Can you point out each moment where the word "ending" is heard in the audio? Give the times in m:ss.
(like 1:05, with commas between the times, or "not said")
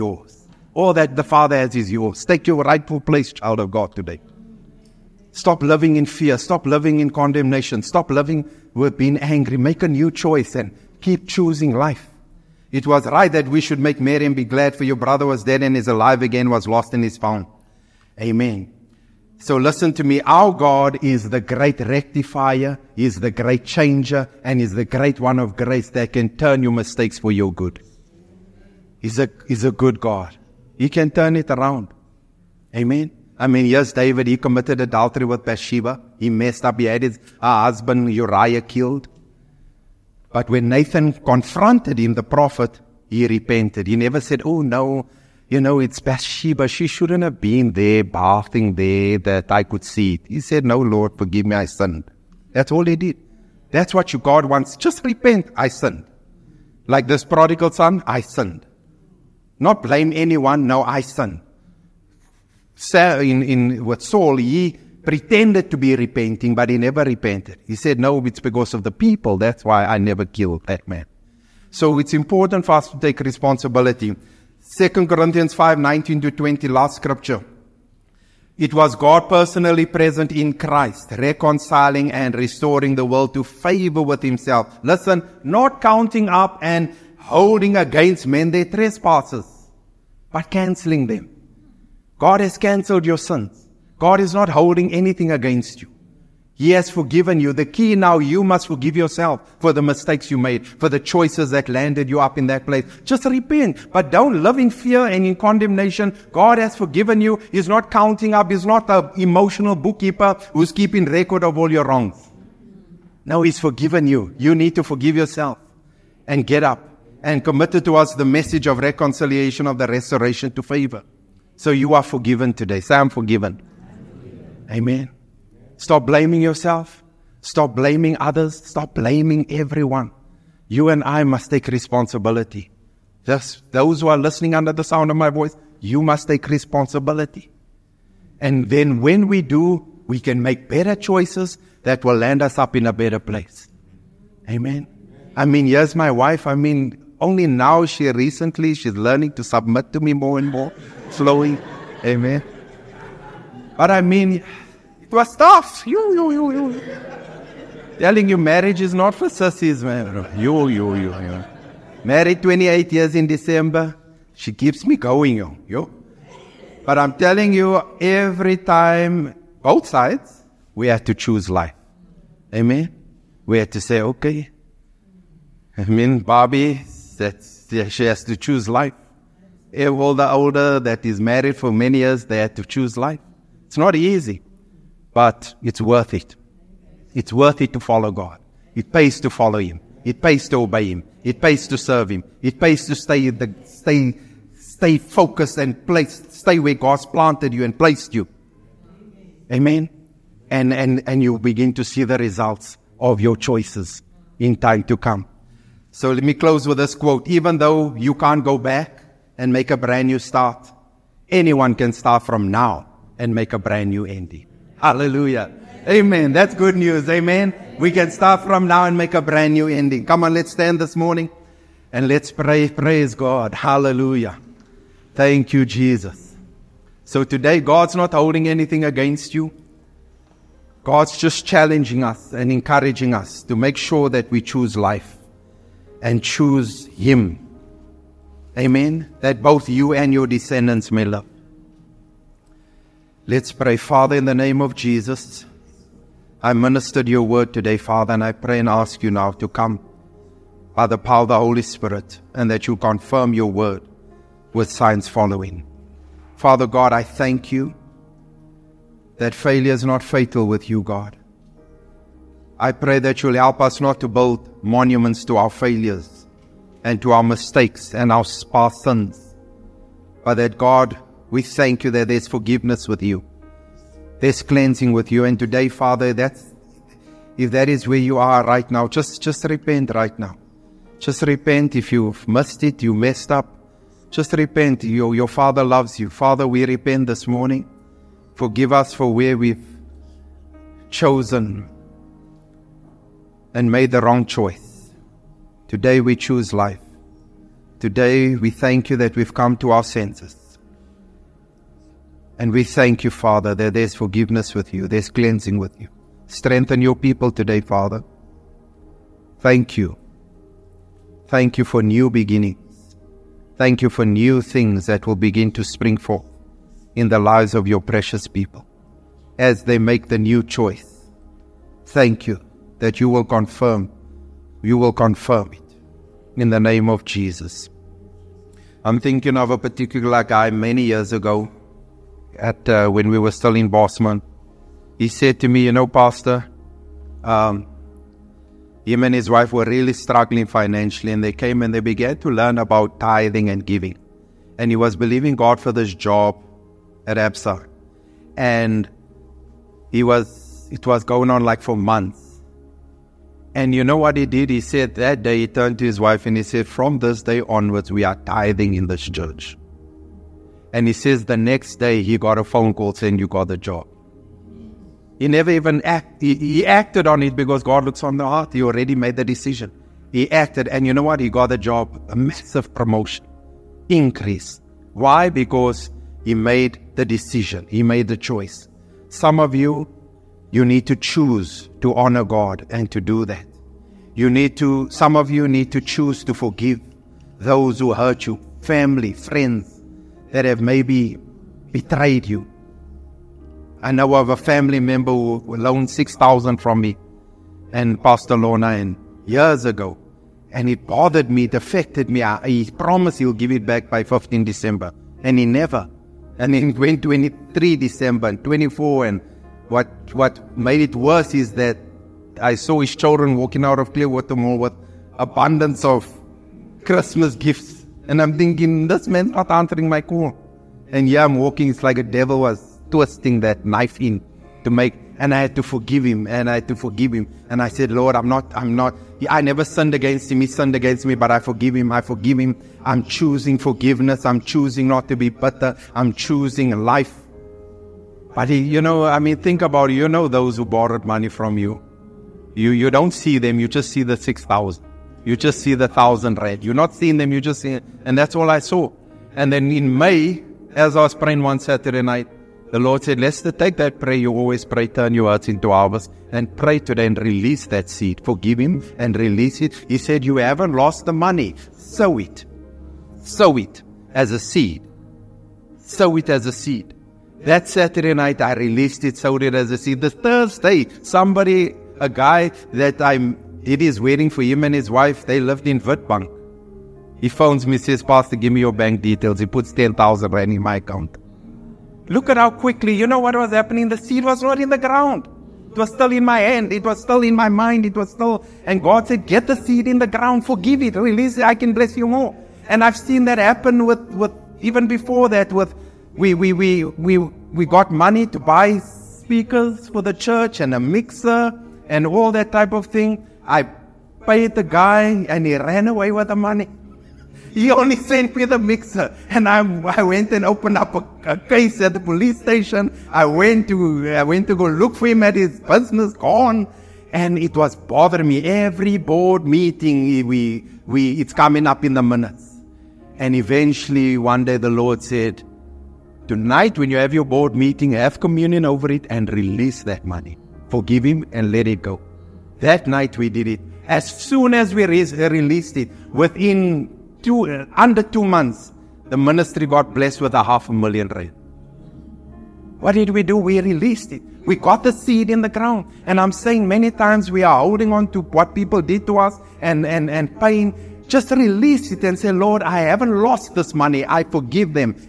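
3:34, 3:39.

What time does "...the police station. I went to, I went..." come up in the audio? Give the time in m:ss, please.
8:31.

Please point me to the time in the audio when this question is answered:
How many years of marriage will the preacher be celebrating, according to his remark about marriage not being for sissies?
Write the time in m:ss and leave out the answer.
2:42.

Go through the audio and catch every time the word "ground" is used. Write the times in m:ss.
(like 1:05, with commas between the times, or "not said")
8:04, 8:10, 9:05.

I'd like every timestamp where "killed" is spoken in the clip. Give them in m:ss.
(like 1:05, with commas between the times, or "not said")
0:38, 1:10.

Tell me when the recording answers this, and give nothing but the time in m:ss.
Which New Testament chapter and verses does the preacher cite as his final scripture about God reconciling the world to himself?
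1:14.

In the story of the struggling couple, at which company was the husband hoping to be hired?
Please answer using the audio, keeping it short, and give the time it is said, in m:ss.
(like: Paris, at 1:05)
ABSA, at 5:47.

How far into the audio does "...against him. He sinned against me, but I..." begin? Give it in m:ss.
7:09.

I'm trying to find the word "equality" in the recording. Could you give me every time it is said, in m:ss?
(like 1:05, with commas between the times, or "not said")
not said.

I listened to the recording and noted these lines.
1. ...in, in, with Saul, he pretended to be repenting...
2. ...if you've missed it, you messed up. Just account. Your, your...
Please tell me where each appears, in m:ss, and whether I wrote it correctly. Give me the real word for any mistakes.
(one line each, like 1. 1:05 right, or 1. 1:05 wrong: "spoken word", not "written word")
1. 1:03 right
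2. 4:41 wrong: "repent", not "account".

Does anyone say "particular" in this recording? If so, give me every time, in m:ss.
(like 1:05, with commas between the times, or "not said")
5:29.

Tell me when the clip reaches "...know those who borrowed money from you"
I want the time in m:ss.
7:20.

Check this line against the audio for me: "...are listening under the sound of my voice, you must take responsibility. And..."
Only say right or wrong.
right.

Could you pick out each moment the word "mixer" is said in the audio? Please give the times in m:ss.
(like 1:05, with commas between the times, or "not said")
8:20, 8:28.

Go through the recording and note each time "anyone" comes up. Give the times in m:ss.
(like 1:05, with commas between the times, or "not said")
1:00, 3:31.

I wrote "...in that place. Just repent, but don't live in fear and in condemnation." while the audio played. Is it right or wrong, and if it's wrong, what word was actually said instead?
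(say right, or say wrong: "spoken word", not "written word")
right.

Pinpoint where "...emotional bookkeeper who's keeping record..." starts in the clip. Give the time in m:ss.
1:49.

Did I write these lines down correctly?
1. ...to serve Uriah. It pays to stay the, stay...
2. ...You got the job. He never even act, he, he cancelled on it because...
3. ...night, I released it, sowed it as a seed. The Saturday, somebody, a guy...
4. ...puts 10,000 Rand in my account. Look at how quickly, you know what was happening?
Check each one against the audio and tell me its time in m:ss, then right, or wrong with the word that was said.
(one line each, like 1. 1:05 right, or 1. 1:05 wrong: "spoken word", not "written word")
1. 3:11 wrong: "Him", not "Uriah"
2. 6:03 wrong: "acted", not "cancelled"
3. 7:48 wrong: "Thursday", not "Saturday"
4. 7:59 right.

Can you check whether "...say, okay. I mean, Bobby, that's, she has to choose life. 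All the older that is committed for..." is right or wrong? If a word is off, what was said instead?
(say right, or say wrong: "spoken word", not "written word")
wrong: "married", not "committed".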